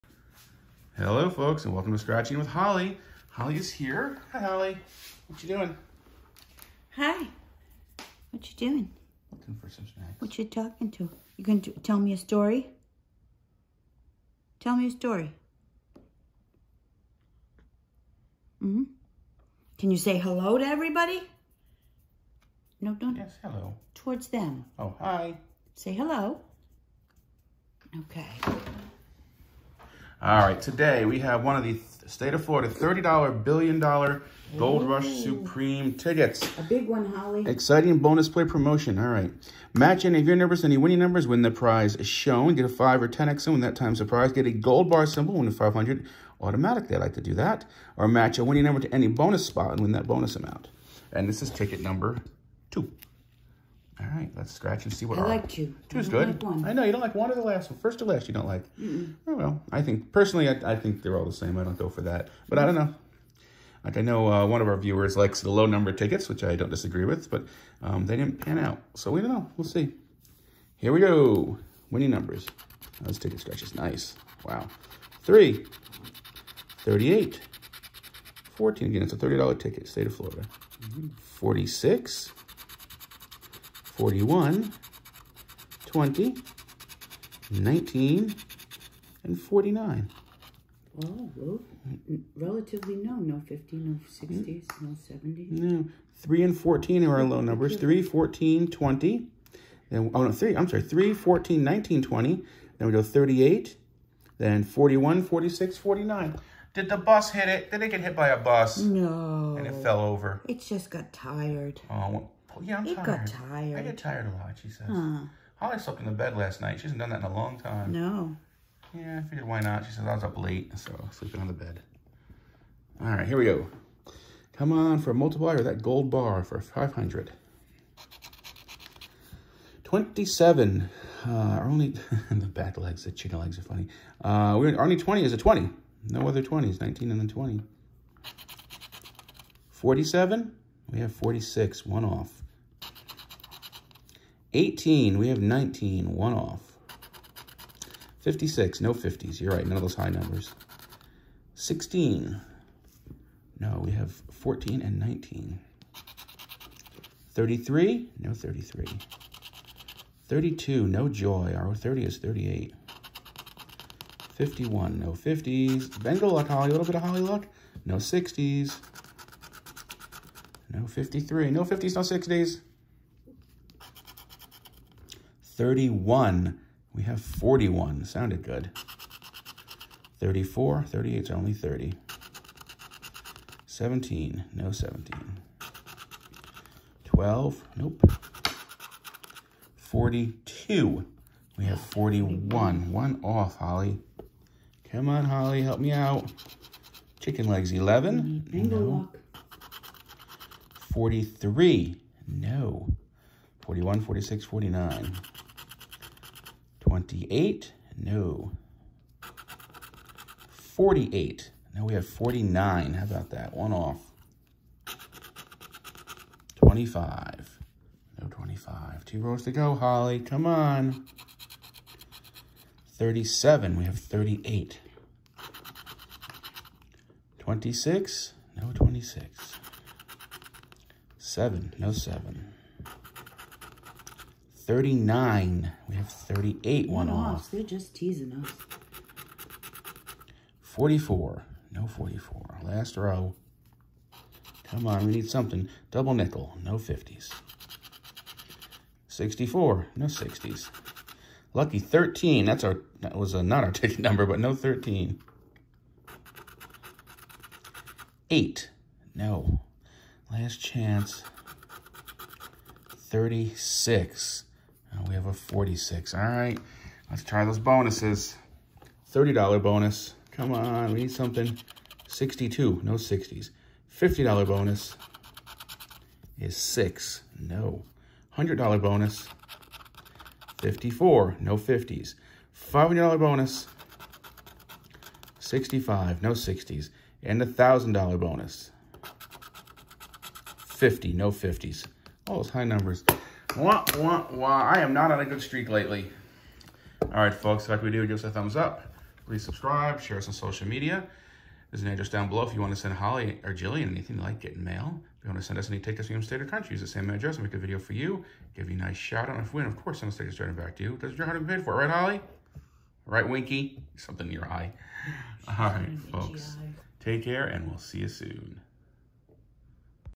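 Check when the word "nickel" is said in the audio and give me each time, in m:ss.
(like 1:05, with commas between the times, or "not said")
4:06.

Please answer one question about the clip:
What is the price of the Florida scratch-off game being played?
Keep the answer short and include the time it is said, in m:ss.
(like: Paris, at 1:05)
$30, at 0:32.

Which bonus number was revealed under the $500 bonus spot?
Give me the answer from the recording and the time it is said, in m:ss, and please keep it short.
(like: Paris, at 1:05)
65, at 4:45.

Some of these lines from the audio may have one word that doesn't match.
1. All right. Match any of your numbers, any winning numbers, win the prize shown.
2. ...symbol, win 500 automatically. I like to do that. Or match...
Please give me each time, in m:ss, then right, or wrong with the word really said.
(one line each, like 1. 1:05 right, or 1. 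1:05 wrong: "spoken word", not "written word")
1. 0:38 right
2. 0:45 right.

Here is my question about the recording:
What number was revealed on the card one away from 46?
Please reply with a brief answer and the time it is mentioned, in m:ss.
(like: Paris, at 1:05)
47, at 2:19.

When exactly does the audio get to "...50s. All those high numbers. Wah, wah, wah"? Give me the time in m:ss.
4:51.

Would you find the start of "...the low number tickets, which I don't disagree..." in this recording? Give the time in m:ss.
1:05.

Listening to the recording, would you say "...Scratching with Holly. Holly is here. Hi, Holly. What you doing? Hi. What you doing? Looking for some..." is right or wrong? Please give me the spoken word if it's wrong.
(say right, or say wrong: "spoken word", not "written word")
right.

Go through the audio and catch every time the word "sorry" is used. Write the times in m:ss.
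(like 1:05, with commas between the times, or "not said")
1:40.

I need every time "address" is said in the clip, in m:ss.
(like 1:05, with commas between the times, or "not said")
5:01, 5:07.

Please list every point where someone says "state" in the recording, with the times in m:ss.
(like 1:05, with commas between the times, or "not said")
0:32, 1:19, 5:06.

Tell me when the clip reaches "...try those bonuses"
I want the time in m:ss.
4:27.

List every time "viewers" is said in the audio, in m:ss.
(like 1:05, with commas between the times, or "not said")
1:04.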